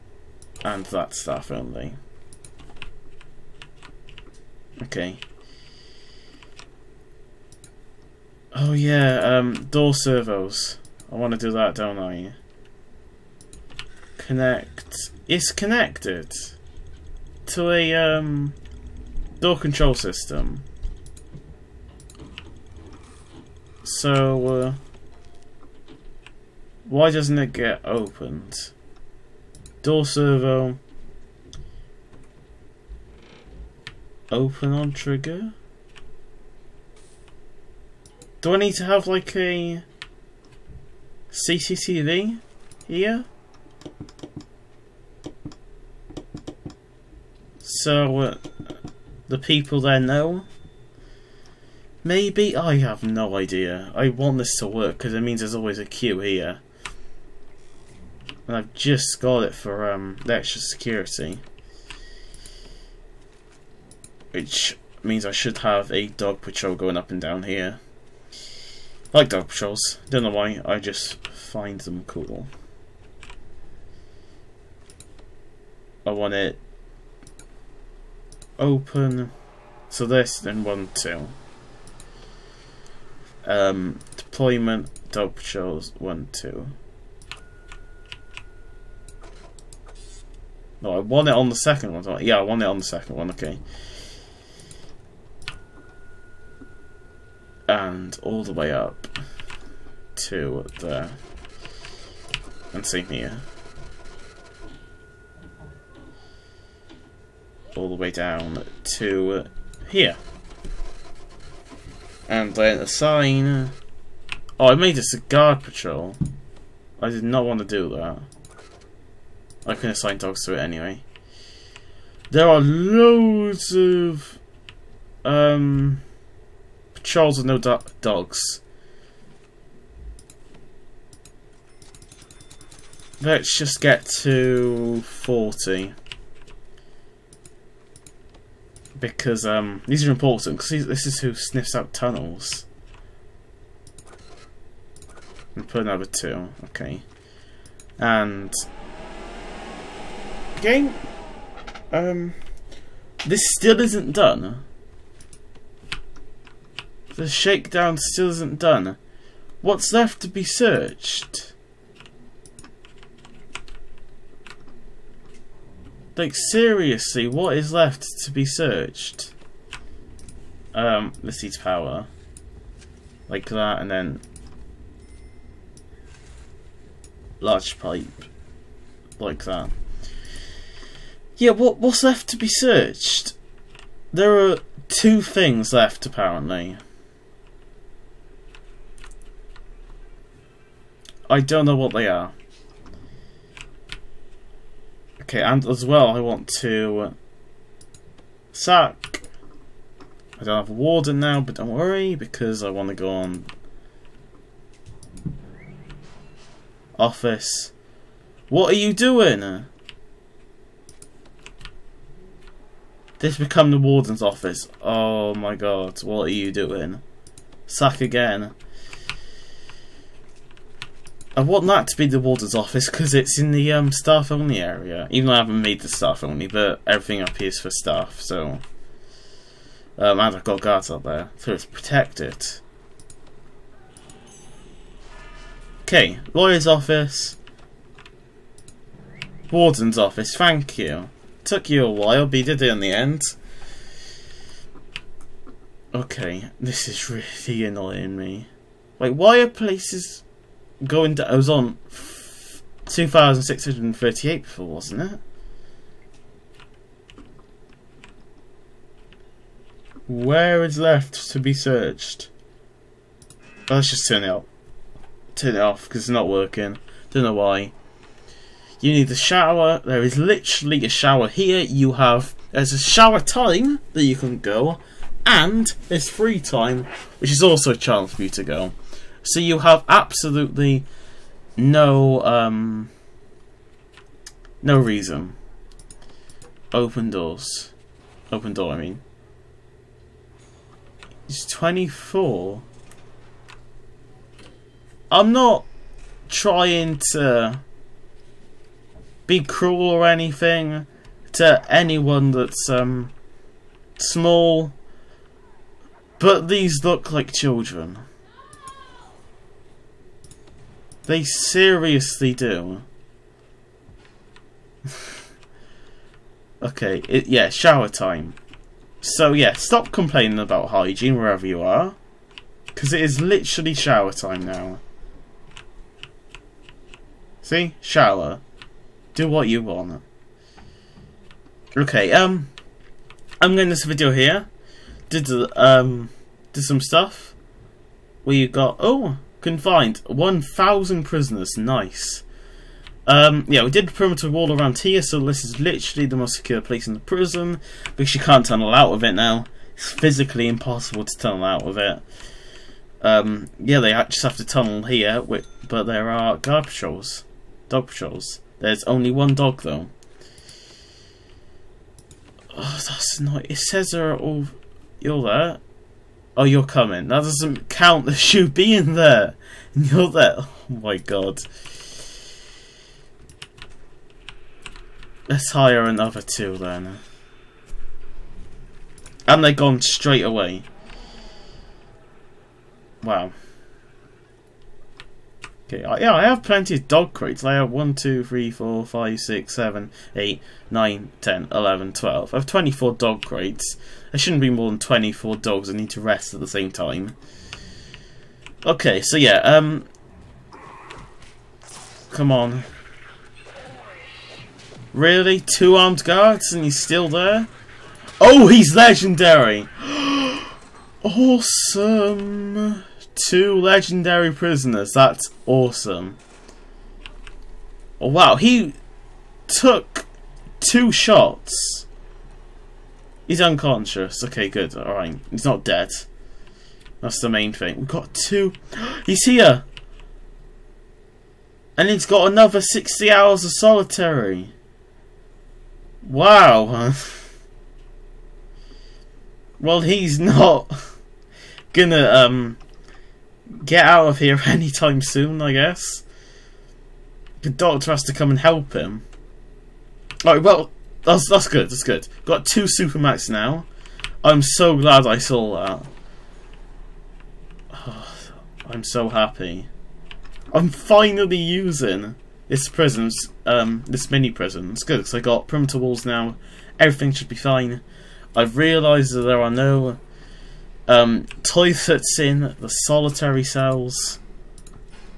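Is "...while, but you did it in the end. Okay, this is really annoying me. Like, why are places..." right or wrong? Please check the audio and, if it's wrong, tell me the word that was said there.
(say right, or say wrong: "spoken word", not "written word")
right.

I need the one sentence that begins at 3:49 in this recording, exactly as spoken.
Um, and I've got guards up there, so protect it.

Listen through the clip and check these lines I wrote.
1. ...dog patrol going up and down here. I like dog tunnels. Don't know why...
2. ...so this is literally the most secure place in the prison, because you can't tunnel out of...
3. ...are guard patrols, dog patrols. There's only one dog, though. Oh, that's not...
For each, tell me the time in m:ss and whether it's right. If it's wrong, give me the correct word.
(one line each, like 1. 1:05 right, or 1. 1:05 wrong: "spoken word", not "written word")
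1. 1:06 wrong: "patrols", not "tunnels"
2. 5:45 right
3. 5:56 right.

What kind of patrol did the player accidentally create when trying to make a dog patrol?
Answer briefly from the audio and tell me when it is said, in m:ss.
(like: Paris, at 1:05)
Cigar patrol, at 1:55.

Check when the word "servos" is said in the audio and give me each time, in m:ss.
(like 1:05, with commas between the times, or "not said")
0:09, 0:30.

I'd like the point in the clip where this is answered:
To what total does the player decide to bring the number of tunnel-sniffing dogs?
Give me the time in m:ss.
2:15.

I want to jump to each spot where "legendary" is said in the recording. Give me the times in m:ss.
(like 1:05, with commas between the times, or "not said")
6:48, 6:53.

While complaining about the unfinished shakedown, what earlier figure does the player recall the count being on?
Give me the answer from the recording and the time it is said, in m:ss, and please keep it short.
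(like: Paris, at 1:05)
2,638, at 4:12.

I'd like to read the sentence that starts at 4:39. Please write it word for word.
So you have absolutely no um, no reason.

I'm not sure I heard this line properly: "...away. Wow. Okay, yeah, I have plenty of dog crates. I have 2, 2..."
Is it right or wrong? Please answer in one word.
wrong.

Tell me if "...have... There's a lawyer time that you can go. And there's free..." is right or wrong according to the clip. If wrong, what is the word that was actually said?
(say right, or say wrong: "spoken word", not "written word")
wrong: "shower", not "lawyer".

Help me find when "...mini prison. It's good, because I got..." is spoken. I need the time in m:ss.
7:44.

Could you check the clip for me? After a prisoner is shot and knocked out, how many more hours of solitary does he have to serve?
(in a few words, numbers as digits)
60.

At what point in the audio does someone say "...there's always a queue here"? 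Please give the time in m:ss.
0:55.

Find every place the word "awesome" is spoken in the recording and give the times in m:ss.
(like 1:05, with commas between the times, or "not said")
6:51, 6:55.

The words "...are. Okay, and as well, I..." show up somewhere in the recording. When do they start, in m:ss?
3:12.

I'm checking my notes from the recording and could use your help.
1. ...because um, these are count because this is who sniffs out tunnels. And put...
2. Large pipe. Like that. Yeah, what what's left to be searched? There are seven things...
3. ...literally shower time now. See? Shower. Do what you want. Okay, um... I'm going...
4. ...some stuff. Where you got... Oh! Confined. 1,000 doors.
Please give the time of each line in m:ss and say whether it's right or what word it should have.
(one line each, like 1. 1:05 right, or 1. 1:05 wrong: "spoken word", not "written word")
1. 2:18 wrong: "important", not "count"
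2. 2:57 wrong: "two", not "seven"
3. 5:23 right
4. 5:36 wrong: "prisoners", not "doors".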